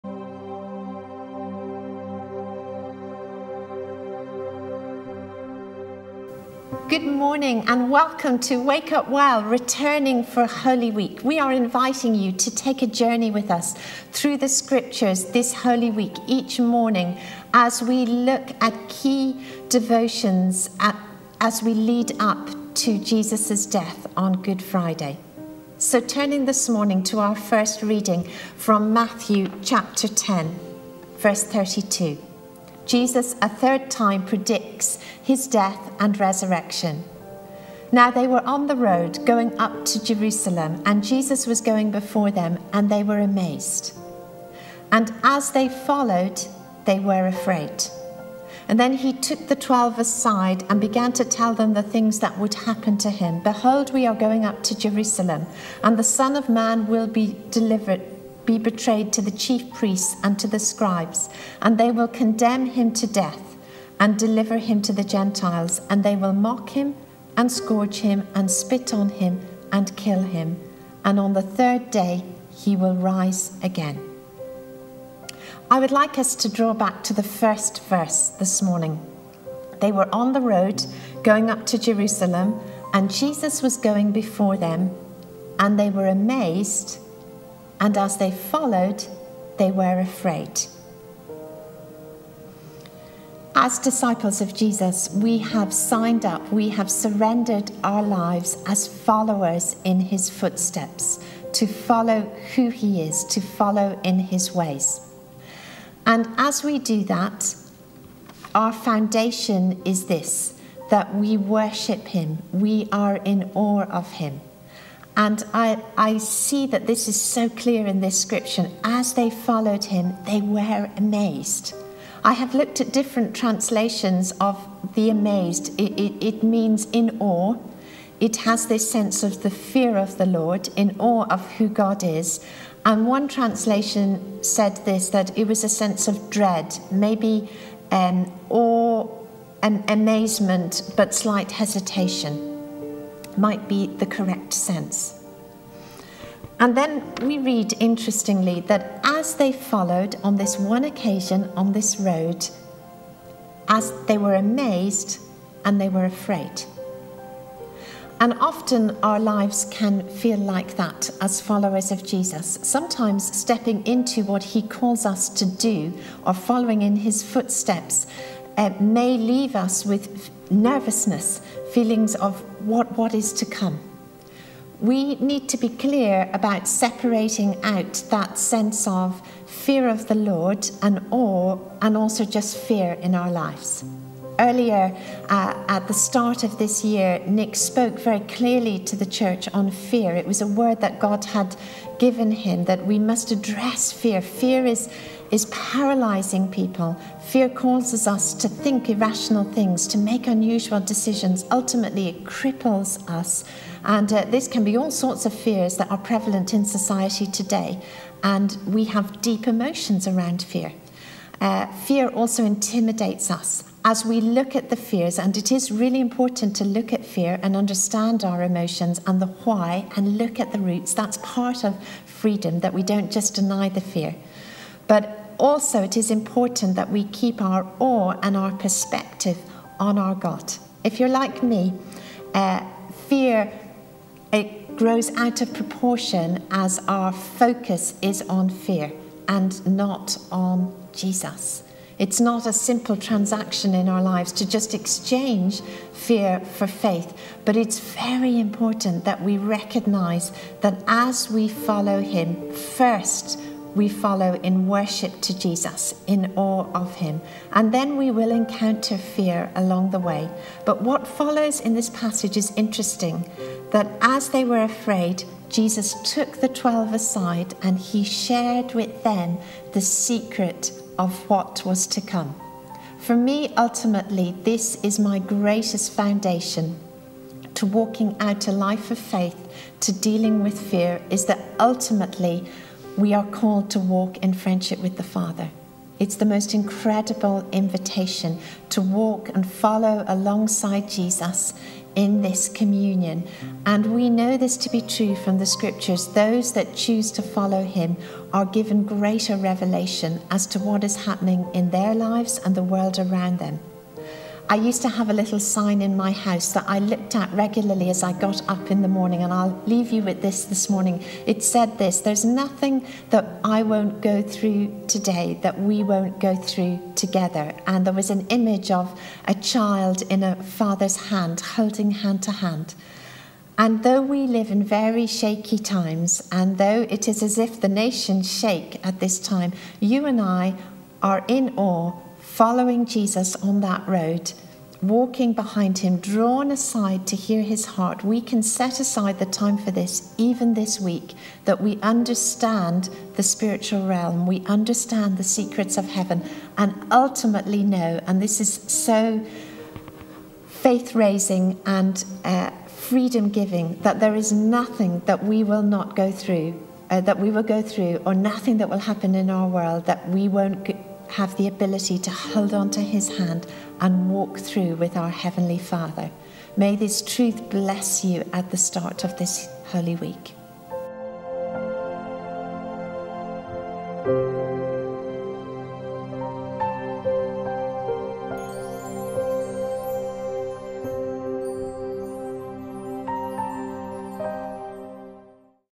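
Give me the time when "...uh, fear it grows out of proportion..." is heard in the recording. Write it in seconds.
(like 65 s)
232 s.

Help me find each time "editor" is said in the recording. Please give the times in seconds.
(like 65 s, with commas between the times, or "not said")
not said.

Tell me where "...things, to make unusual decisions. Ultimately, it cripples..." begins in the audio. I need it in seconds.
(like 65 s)
199 s.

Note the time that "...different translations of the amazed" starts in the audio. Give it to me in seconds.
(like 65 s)
122 s.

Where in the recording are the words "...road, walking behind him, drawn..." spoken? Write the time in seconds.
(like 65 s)
333 s.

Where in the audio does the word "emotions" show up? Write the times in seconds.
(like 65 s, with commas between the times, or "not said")
209 s, 218 s.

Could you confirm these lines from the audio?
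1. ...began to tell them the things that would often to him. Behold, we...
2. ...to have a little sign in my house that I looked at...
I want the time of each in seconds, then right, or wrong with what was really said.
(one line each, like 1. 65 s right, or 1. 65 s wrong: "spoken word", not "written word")
1. 50 s wrong: "happen", not "often"
2. 304 s right.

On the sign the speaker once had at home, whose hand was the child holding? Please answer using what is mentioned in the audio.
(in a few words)
A father's.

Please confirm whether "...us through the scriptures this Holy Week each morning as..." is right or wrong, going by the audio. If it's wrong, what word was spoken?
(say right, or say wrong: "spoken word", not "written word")
right.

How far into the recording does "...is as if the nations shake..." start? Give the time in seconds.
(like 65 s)
327 s.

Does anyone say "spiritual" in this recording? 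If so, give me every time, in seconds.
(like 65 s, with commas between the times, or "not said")
343 s.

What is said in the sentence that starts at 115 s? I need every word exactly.
And I, I see that this is so clear in this scripture.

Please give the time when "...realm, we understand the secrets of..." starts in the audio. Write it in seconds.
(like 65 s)
343 s.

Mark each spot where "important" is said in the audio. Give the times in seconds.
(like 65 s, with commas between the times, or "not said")
215 s, 226 s, 248 s.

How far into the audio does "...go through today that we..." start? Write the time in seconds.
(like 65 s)
314 s.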